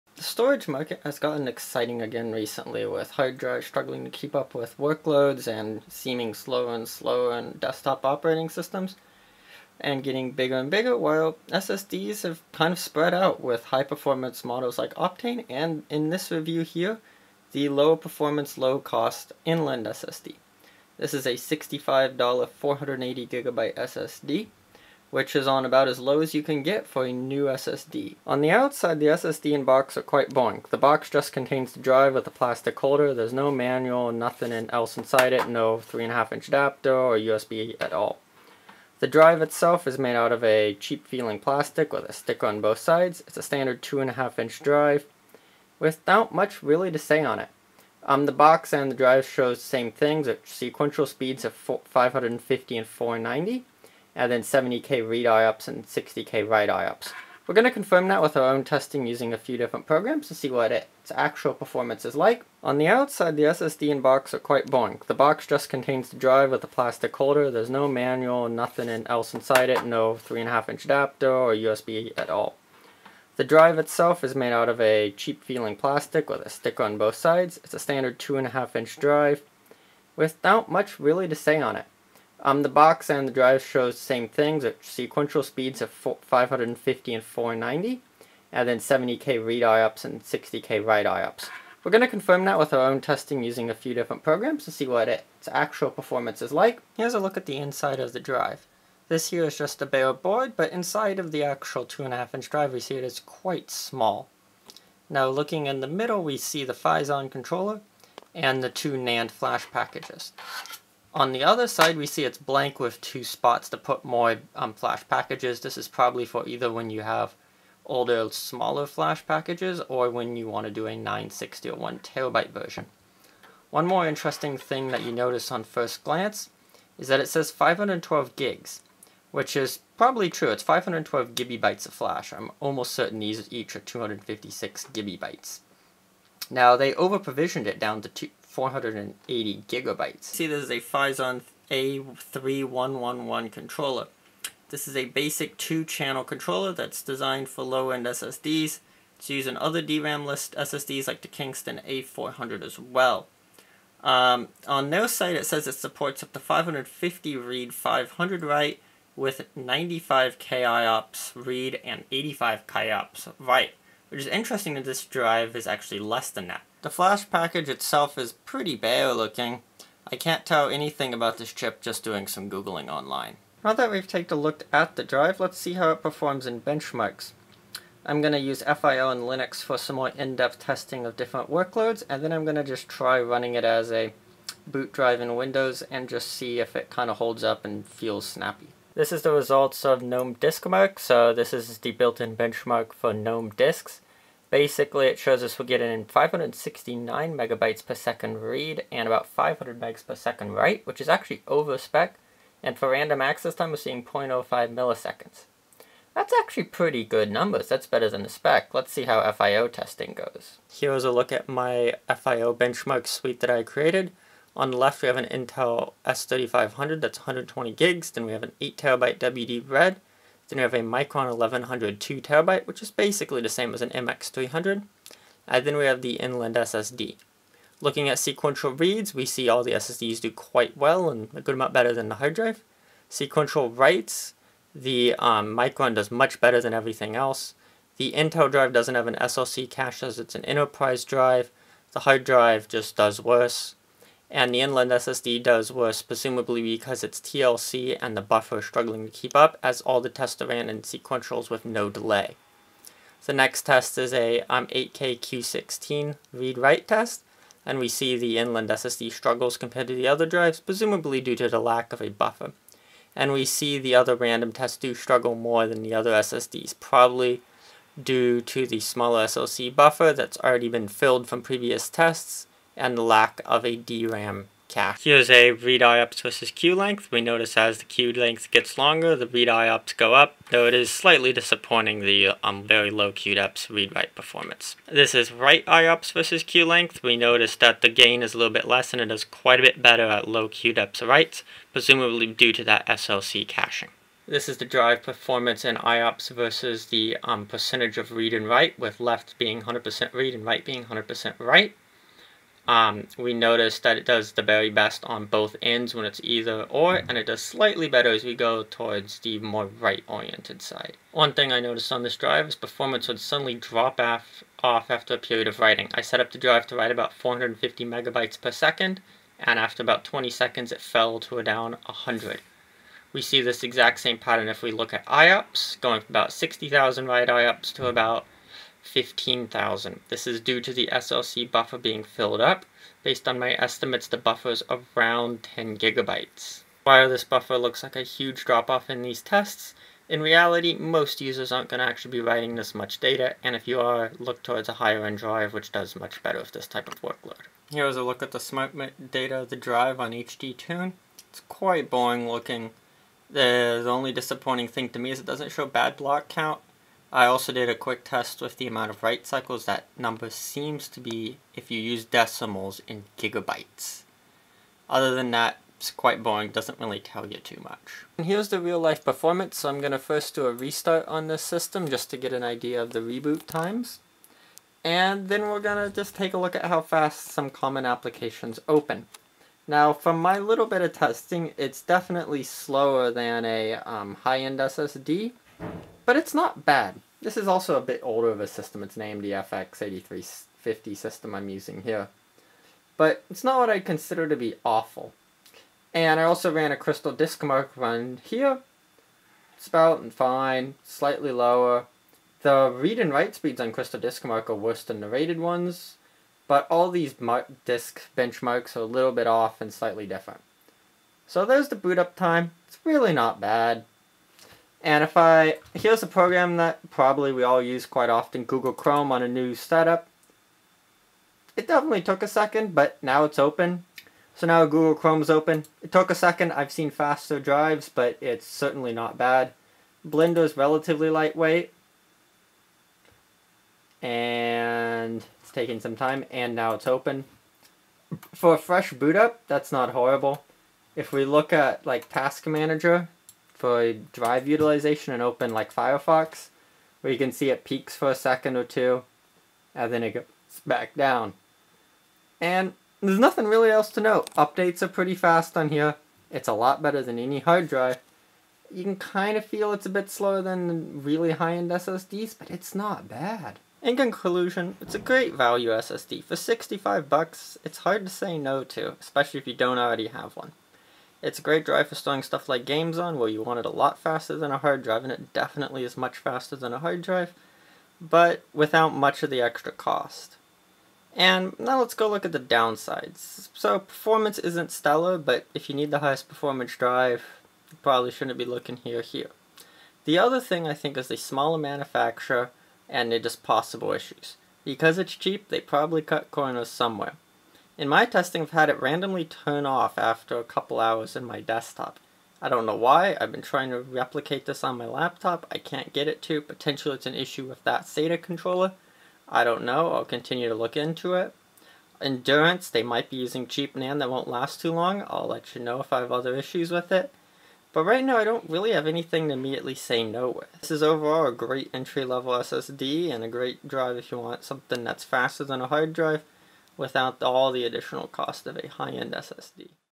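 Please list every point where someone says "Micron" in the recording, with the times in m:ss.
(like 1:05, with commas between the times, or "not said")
3:40, 3:55.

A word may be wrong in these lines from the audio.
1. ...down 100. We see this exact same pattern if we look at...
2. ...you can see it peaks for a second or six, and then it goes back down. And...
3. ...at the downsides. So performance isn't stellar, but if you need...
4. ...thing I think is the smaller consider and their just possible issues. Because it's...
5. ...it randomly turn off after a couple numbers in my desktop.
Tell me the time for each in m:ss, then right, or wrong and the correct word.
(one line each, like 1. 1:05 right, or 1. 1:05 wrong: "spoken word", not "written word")
1. 5:21 right
2. 7:27 wrong: "two", not "six"
3. 8:02 right
4. 8:10 wrong: "manufacturer", not "consider"
5. 8:18 wrong: "hours", not "numbers".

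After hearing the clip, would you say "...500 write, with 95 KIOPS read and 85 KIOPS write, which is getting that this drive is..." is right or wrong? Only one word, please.
wrong.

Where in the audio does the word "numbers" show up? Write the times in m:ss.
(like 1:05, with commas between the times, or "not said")
3:27, 5:59.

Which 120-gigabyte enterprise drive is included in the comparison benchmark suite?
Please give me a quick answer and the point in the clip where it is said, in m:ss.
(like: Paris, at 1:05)
Intel S3500, at 3:35.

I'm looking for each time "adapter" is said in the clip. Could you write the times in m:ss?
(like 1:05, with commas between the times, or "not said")
0:36, 1:10.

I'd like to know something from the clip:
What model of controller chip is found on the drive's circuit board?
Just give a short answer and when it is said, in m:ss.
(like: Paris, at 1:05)
Phison A3111, at 2:20.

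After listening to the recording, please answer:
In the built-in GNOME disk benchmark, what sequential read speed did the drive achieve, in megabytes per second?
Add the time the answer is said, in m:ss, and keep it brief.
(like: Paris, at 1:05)
569, at 3:16.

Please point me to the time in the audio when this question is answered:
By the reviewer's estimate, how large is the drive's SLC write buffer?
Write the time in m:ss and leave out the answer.
5:35.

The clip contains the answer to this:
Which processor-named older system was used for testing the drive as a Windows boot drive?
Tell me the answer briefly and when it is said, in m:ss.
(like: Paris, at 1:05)
FX8350, at 6:29.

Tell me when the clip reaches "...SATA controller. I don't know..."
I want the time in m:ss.
8:27.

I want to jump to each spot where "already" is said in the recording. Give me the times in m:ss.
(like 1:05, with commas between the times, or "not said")
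4:30, 7:49.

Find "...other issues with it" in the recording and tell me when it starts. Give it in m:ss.
8:36.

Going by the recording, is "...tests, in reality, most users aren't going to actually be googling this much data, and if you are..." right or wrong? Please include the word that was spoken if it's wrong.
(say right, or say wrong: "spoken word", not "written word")
wrong: "writing", not "googling".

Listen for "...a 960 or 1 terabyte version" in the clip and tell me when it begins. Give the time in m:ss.
2:00.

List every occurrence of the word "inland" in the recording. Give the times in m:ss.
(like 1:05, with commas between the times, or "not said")
0:19, 3:46, 4:04, 4:18.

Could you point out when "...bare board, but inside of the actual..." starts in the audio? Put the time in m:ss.
1:39.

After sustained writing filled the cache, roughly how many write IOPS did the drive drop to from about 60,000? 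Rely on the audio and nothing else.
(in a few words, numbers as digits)
15,000.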